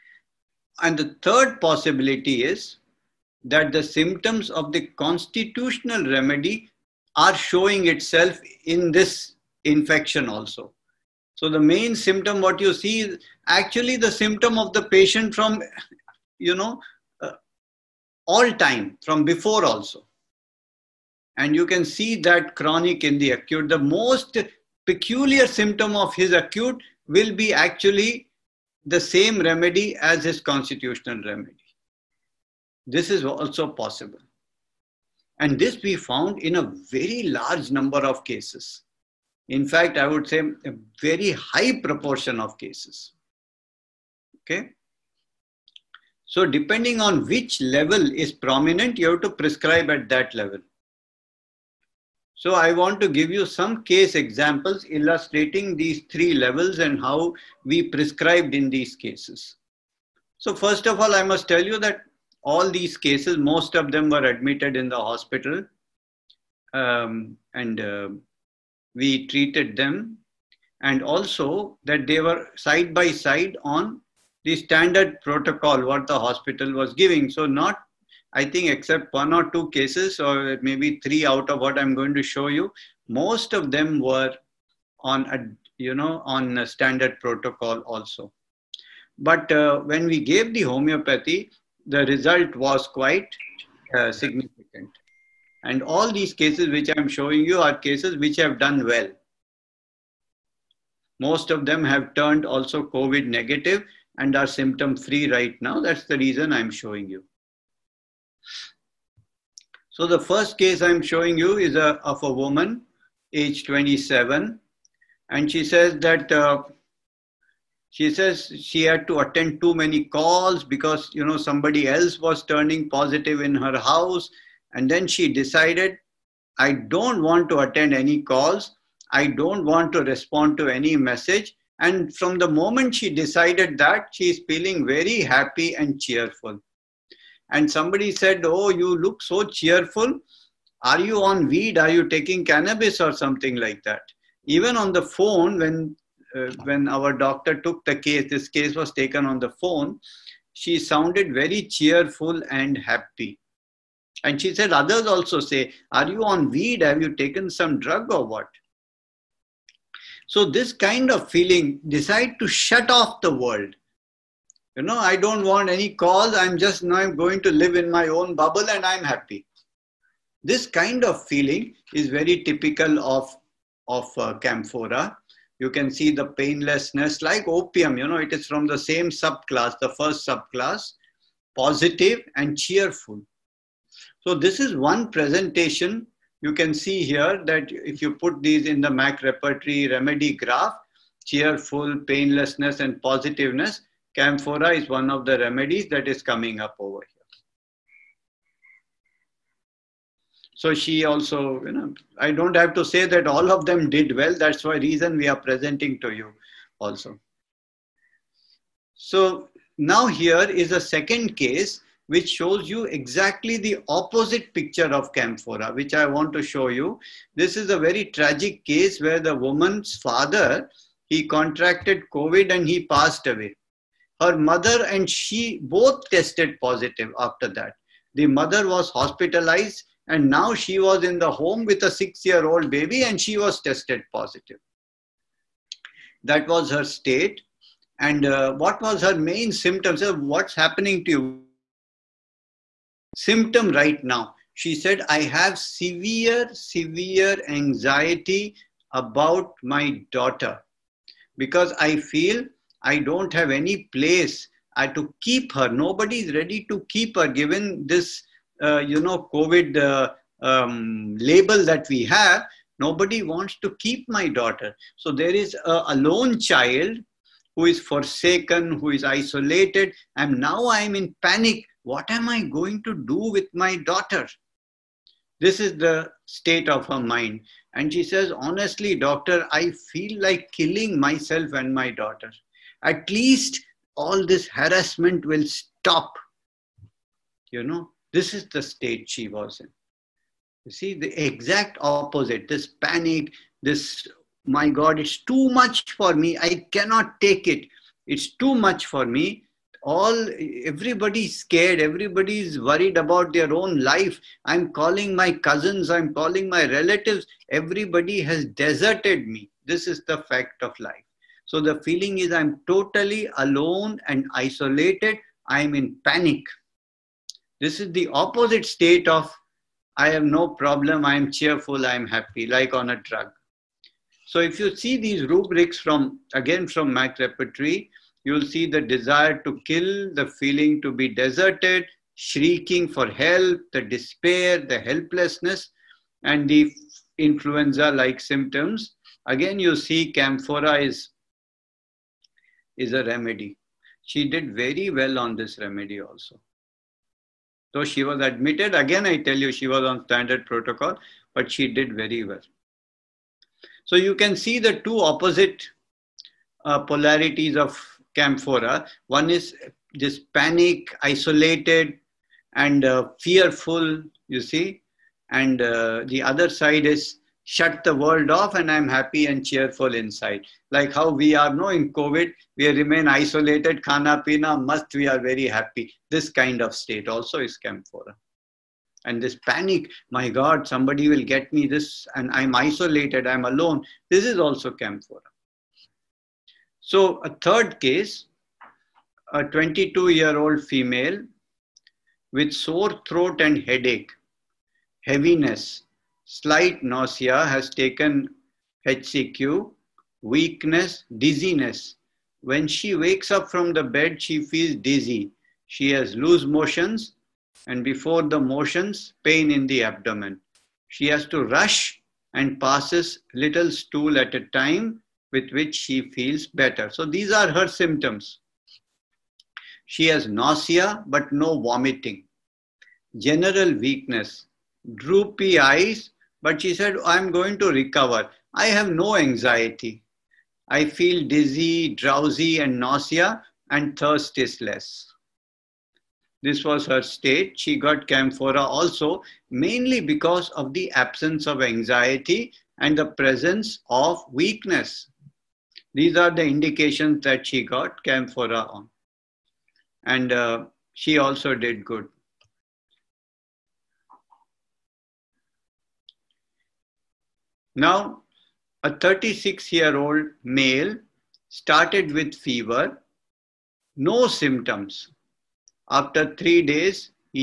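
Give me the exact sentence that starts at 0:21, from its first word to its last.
And you can see that chronic in the acute.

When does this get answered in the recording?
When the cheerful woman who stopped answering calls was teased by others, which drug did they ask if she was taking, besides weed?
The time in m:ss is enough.
2:22.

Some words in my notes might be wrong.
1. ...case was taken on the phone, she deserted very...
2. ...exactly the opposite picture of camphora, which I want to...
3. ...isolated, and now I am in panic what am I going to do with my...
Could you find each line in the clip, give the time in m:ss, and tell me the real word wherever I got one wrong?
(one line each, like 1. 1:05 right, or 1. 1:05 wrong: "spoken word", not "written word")
1. 2:28 wrong: "sounded", not "deserted"
2. 3:32 right
3. 4:29 right.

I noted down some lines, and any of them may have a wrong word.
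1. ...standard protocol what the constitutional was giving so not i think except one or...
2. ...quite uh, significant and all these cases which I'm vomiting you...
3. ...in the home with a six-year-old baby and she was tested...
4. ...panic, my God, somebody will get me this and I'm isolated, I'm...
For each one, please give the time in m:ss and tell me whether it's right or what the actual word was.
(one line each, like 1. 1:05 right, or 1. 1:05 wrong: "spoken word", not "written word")
1. 1:14 wrong: "hospital", not "constitutional"
2. 1:32 wrong: "showing", not "vomiting"
3. 3:51 right
4. 6:19 right.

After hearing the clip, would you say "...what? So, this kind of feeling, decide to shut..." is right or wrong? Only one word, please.
right.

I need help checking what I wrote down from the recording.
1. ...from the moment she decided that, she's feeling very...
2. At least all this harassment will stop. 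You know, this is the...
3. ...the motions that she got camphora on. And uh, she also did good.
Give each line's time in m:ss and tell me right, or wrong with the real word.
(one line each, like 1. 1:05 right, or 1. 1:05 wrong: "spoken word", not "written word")
1. 2:12 right
2. 4:42 right
3. 7:26 wrong: "indications", not "motions".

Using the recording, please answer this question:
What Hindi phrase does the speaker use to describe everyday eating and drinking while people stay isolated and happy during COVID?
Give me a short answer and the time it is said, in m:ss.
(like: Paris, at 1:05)
khana pina, at 6:13.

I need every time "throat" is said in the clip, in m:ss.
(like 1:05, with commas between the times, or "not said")
6:33.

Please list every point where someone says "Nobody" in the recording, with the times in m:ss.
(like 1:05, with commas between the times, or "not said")
4:15, 4:22.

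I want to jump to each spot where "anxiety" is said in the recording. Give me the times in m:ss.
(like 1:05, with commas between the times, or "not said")
4:07, 7:09, 7:21.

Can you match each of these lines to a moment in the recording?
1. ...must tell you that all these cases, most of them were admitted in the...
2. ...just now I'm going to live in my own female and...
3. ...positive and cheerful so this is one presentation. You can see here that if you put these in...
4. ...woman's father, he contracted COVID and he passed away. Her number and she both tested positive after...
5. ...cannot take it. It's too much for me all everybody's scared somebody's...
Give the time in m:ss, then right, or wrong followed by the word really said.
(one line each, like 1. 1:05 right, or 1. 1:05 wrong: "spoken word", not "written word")
1. 1:01 right
2. 2:46 wrong: "bubble", not "female"
3. 3:01 right
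4. 3:39 wrong: "mother", not "number"
5. 4:56 wrong: "everybody", not "somebody".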